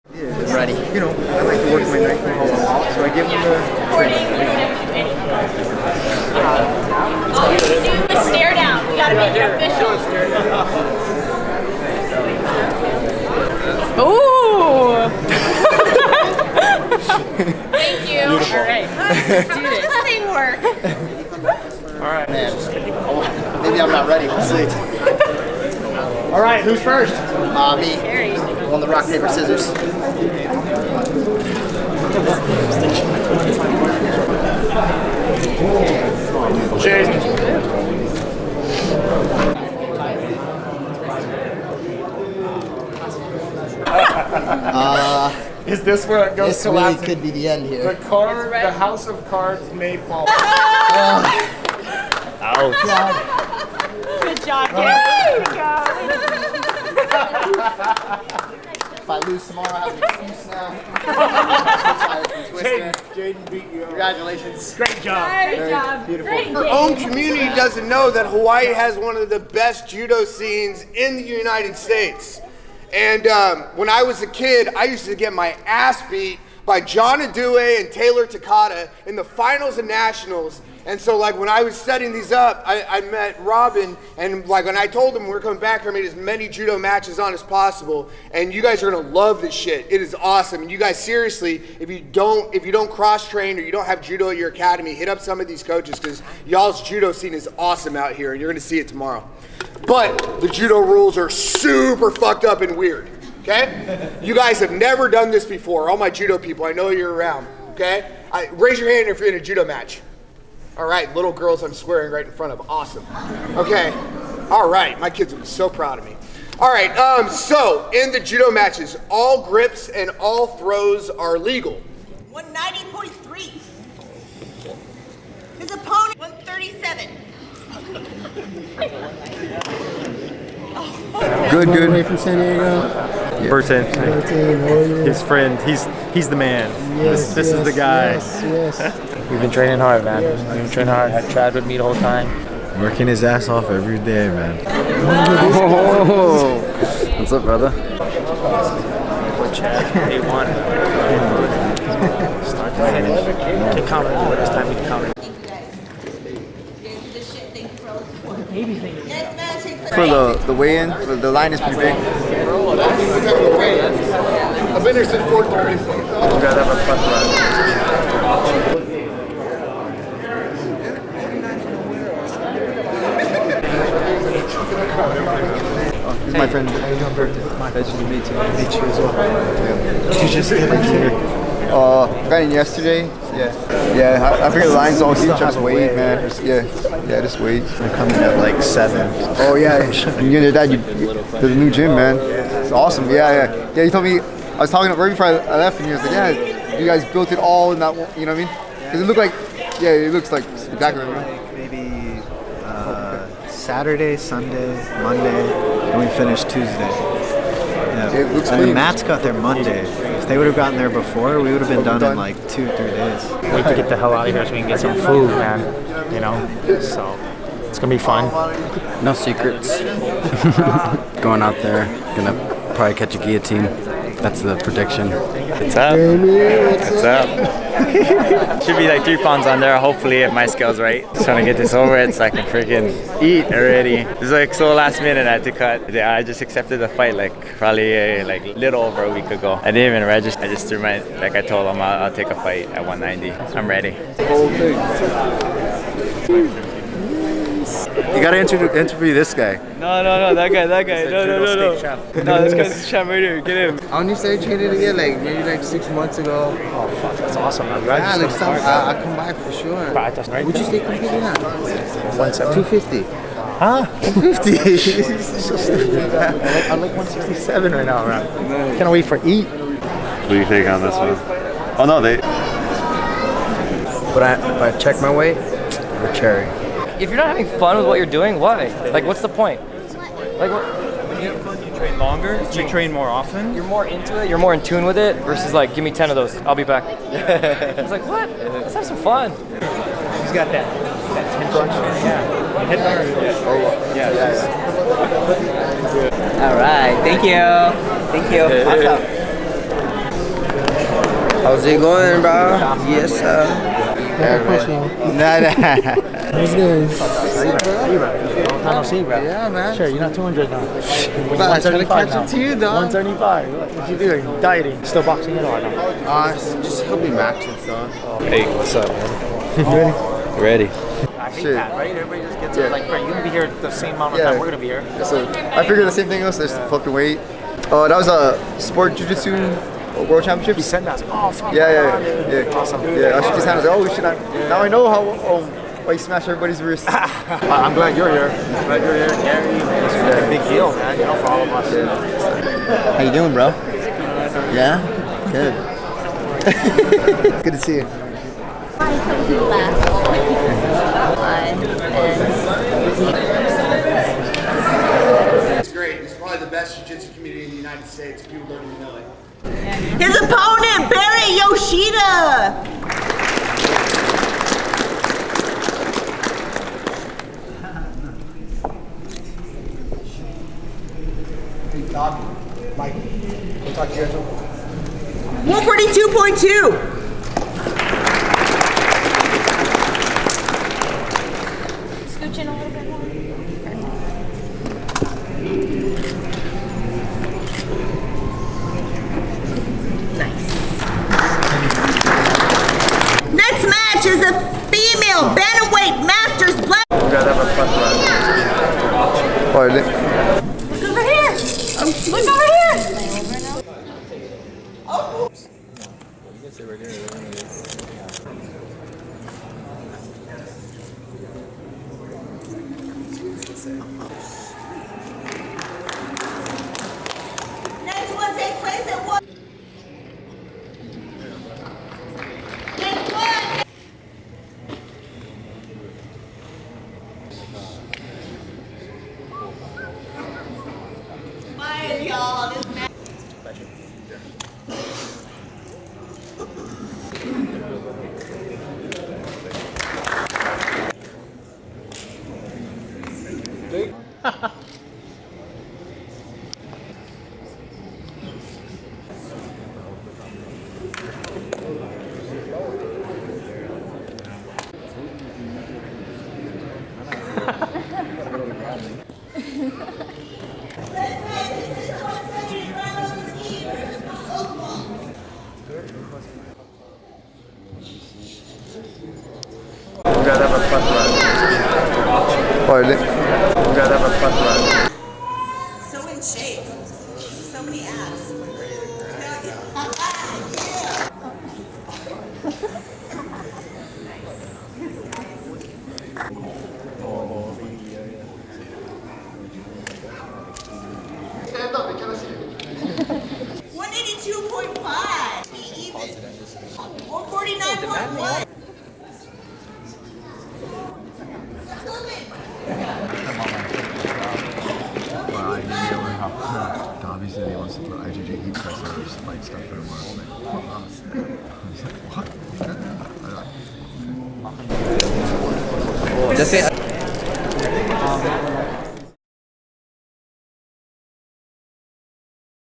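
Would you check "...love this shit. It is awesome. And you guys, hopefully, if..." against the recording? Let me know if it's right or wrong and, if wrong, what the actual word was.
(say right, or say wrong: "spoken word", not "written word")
wrong: "seriously", not "hopefully".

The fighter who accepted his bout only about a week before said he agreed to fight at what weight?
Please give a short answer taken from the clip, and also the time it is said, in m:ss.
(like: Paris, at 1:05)
190, at 4:02.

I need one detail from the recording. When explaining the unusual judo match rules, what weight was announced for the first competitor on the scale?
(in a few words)
190.3.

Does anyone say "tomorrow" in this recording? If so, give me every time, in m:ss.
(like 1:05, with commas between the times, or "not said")
0:59, 1:38.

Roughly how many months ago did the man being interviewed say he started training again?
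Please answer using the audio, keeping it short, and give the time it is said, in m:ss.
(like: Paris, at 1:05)
6 months, at 4:15.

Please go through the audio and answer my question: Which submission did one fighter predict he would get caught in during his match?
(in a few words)
guillotine.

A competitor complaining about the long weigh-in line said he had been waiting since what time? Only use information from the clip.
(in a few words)
4:30.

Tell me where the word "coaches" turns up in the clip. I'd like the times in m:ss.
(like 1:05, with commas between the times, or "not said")
1:35.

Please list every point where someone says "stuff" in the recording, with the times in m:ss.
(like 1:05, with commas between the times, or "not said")
5:17, 8:29.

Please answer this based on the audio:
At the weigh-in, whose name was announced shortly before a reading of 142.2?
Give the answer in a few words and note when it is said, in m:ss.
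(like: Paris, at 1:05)
Barry Yoshida, at 6:00.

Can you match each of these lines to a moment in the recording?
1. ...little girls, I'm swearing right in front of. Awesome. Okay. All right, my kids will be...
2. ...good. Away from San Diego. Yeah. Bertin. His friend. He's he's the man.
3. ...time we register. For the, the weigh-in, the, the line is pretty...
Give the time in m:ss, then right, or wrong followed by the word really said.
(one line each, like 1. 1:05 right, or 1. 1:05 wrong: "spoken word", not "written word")
1. 1:51 right
2. 2:11 right
3. 2:34 wrong: "counter", not "register".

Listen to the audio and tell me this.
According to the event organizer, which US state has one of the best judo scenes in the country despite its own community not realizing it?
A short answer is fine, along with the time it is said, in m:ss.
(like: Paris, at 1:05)
Hawaii, at 1:08.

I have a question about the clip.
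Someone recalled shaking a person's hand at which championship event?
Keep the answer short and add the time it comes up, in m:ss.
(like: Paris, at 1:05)
sport jujitsu World Championships, at 5:28.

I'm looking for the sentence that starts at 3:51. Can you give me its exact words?
Just trying to get this over it so I can freaking eat already.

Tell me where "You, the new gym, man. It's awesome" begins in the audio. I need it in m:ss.
3:10.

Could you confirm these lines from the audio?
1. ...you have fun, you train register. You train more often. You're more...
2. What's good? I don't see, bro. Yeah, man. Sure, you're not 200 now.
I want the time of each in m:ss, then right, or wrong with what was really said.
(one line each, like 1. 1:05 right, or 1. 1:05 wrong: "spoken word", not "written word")
1. 4:41 wrong: "longer", not "register"
2. 5:06 right.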